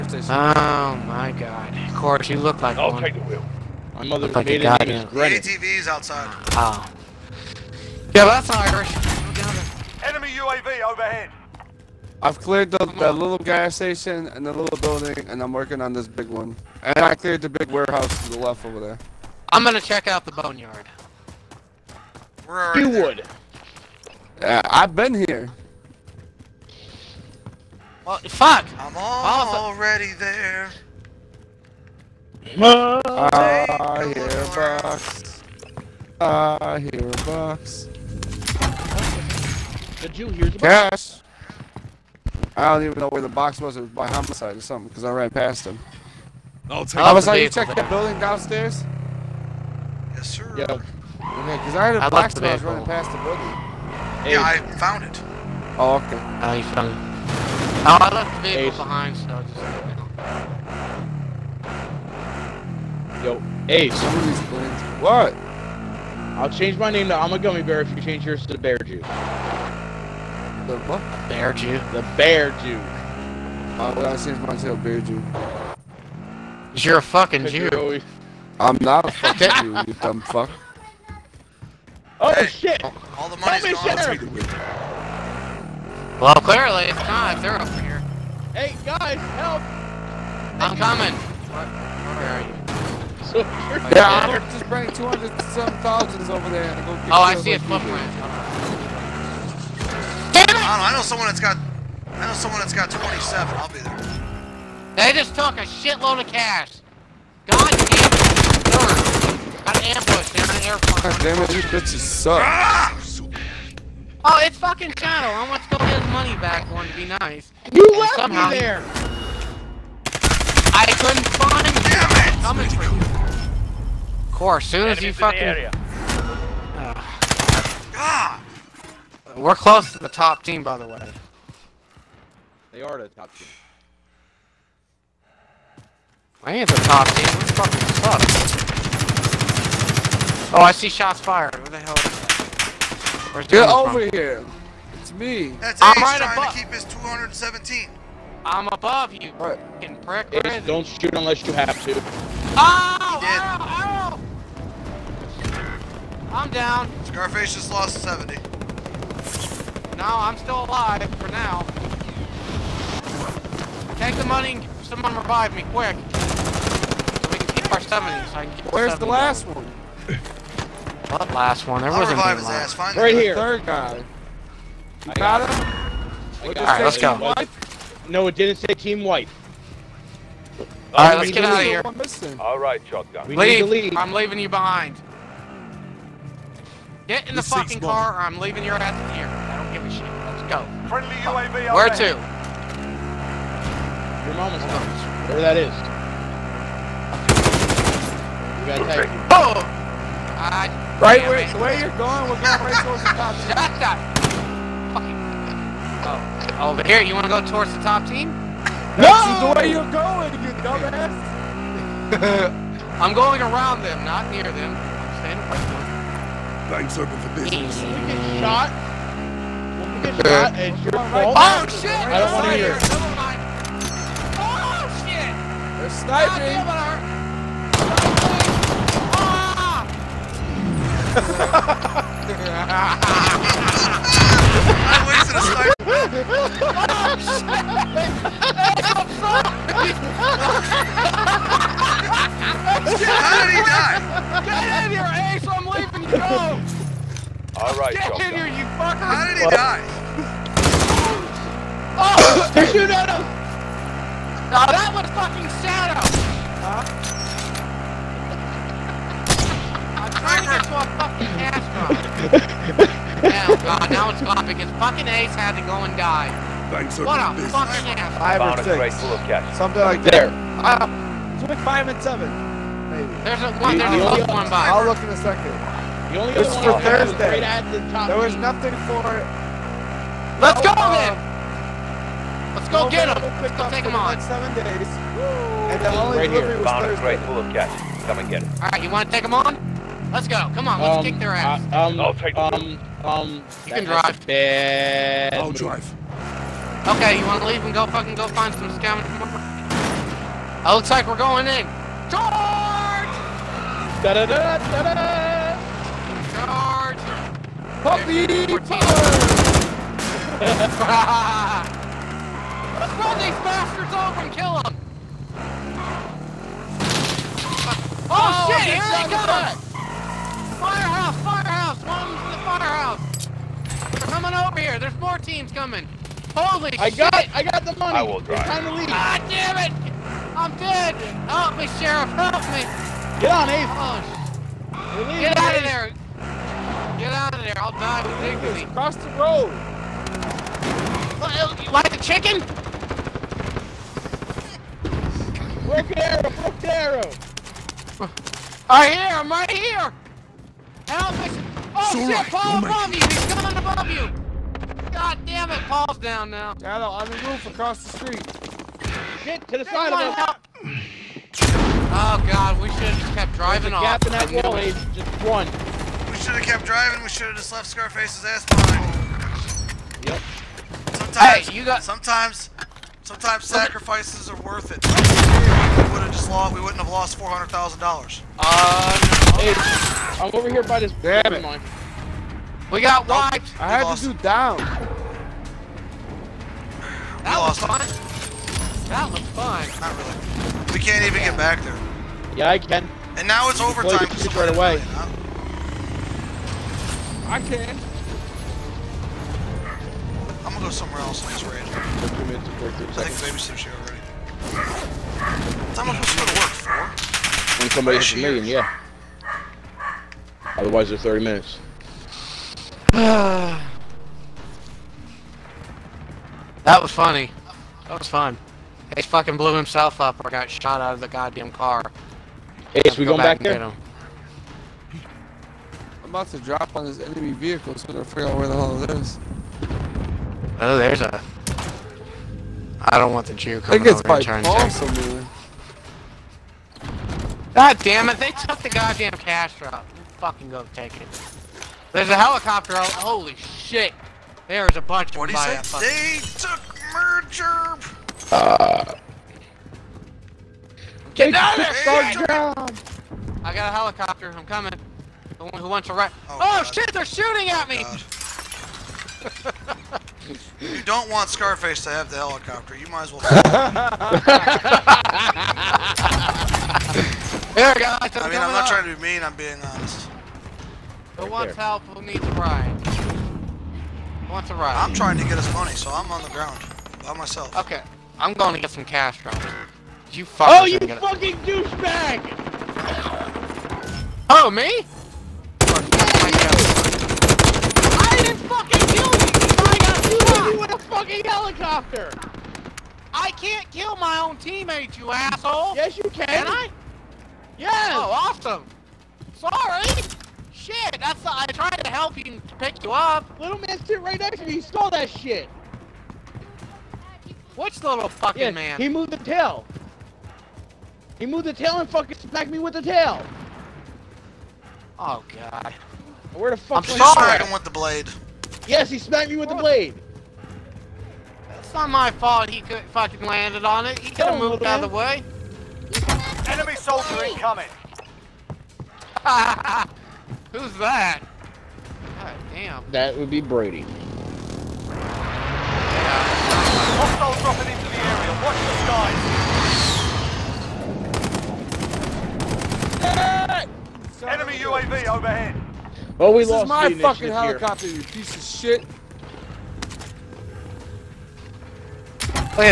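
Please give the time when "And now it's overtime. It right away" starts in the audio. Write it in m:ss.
6:33.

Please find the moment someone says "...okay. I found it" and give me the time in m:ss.
0:55.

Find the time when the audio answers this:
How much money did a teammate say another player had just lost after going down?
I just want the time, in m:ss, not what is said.
2:38.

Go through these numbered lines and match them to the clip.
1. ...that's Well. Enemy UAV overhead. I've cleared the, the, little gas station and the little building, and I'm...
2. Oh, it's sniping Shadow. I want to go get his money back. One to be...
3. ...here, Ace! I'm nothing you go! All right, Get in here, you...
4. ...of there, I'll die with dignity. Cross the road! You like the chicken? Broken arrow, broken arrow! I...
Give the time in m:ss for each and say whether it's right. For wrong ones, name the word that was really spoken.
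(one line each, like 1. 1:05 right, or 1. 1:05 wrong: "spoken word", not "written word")
1. 0:08 wrong: "Irish", not "Well"
2. 1:54 wrong: "fucking", not "sniping"
3. 4:04 wrong: "leaving", not "nothing"
4. 5:37 right.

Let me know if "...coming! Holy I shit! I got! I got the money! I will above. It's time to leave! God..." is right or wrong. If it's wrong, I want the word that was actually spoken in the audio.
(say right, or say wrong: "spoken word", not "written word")
wrong: "drive", not "above".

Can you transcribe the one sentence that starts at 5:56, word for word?
Shadow, on the roof across the street.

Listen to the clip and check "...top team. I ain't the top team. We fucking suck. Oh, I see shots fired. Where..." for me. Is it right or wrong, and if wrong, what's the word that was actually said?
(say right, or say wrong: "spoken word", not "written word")
right.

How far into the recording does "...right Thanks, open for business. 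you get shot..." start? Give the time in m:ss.
3:35.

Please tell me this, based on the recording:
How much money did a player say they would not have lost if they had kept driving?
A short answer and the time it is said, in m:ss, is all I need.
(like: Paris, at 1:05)
400,000, at 6:17.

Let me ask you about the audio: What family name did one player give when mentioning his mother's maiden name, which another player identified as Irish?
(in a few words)
Grenny.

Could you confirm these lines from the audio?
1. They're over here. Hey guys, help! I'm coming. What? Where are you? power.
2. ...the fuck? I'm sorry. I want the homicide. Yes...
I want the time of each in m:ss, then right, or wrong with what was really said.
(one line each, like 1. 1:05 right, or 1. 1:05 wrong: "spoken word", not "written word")
1. 1:27 wrong: "soldier", not "power"
2. 8:36 wrong: "blade", not "homicide".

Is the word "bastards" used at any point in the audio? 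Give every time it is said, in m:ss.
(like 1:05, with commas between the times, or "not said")
5:13.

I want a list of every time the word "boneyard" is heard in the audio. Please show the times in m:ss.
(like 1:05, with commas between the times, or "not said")
0:20.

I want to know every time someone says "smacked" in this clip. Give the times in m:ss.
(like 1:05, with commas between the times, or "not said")
8:32, 8:38.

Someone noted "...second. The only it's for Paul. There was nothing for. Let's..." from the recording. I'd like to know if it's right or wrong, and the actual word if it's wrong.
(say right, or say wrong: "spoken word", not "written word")
wrong: "Thursday", not "Paul".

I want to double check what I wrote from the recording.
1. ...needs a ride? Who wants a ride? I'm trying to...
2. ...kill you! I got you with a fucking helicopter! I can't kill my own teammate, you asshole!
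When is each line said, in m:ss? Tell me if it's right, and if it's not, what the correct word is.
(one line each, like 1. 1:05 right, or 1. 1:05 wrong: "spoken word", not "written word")
1. 7:52 right
2. 8:08 right.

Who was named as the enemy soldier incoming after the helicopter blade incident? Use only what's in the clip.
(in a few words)
Brady.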